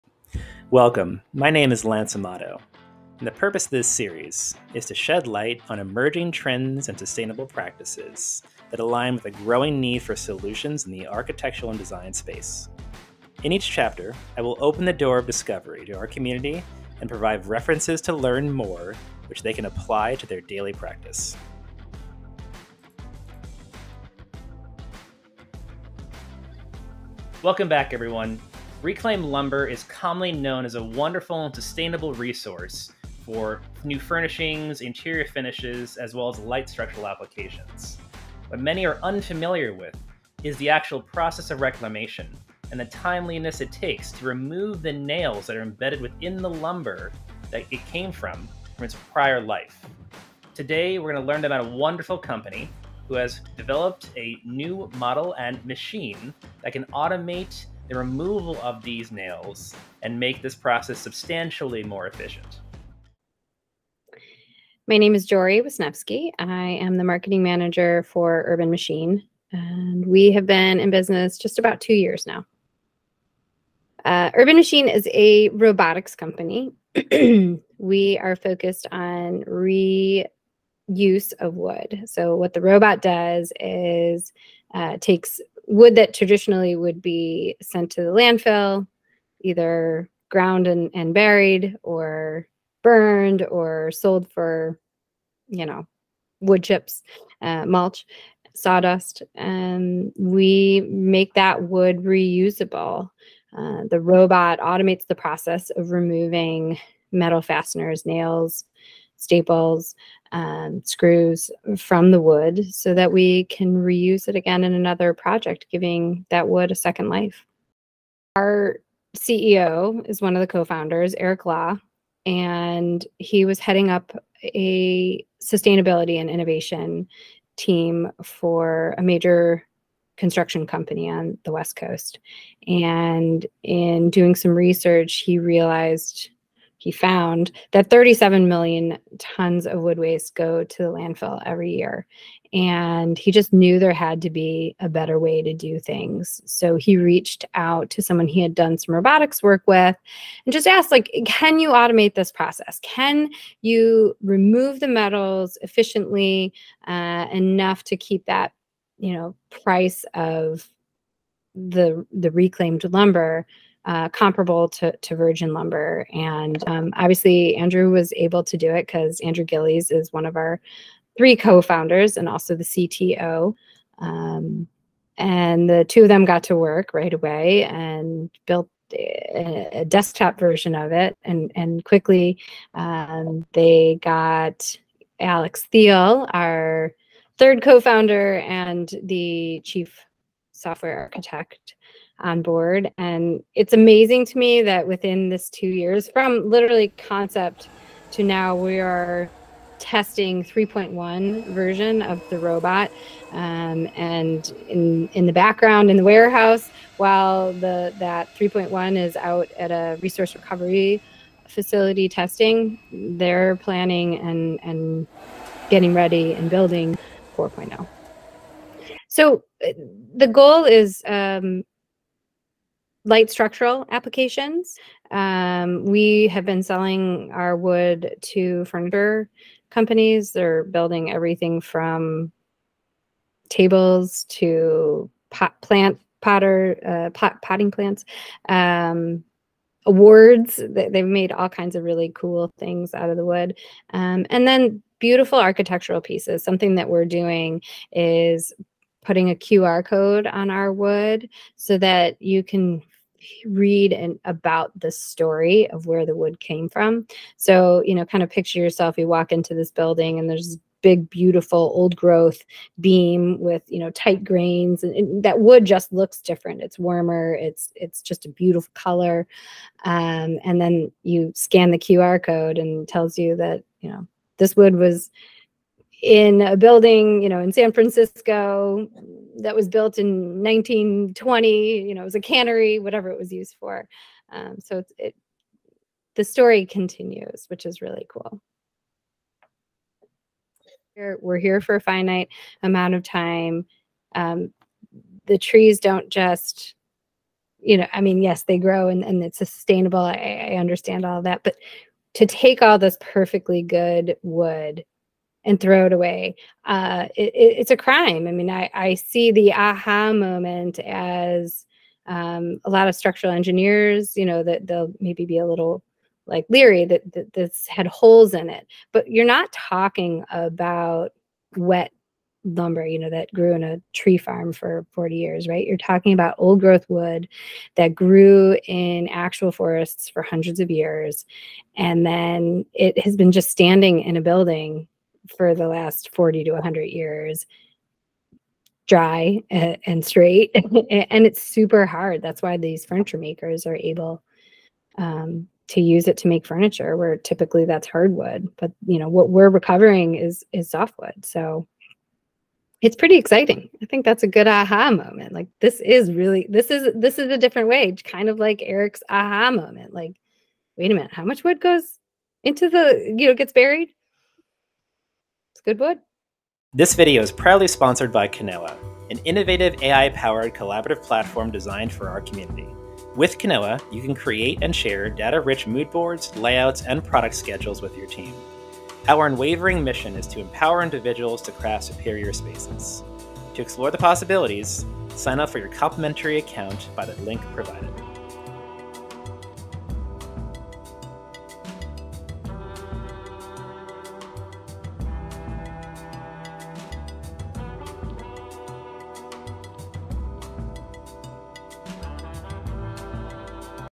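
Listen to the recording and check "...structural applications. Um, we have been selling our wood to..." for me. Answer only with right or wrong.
right.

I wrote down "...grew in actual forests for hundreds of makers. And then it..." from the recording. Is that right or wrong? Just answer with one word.
wrong.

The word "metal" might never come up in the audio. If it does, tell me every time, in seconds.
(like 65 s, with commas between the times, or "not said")
107 s, 154 s.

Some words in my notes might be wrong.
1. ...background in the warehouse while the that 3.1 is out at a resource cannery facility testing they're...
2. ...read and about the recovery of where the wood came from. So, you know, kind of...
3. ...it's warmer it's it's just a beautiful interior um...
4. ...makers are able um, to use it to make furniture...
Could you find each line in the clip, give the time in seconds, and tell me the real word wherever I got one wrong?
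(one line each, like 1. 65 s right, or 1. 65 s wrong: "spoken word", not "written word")
1. 205 s wrong: "recovery", not "cannery"
2. 253 s wrong: "story", not "recovery"
3. 266 s wrong: "color", not "interior"
4. 343 s right.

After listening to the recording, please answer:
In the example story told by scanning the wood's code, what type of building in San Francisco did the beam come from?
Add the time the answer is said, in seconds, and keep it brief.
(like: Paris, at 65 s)
a cannery, at 282 s.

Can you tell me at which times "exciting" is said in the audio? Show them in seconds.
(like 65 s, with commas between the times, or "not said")
353 s.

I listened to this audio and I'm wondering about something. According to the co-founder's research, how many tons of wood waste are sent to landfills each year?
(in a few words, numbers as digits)
37 million tons.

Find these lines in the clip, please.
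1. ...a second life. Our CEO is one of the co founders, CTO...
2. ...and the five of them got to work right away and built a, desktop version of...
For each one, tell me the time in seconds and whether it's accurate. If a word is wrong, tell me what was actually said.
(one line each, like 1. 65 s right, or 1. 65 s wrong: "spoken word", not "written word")
1. 116 s wrong: "Eric", not "CTO"
2. 175 s wrong: "two", not "five".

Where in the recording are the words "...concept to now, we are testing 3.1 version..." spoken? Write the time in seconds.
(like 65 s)
196 s.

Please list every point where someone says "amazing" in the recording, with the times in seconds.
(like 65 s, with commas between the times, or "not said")
193 s.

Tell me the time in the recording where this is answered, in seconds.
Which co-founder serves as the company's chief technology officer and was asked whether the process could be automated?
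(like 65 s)
169 s.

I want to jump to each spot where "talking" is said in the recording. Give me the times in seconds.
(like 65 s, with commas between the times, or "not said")
319 s, 325 s.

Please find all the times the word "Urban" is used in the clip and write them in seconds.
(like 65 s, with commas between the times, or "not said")
68 s, 74 s.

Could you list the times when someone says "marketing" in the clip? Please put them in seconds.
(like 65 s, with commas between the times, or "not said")
67 s.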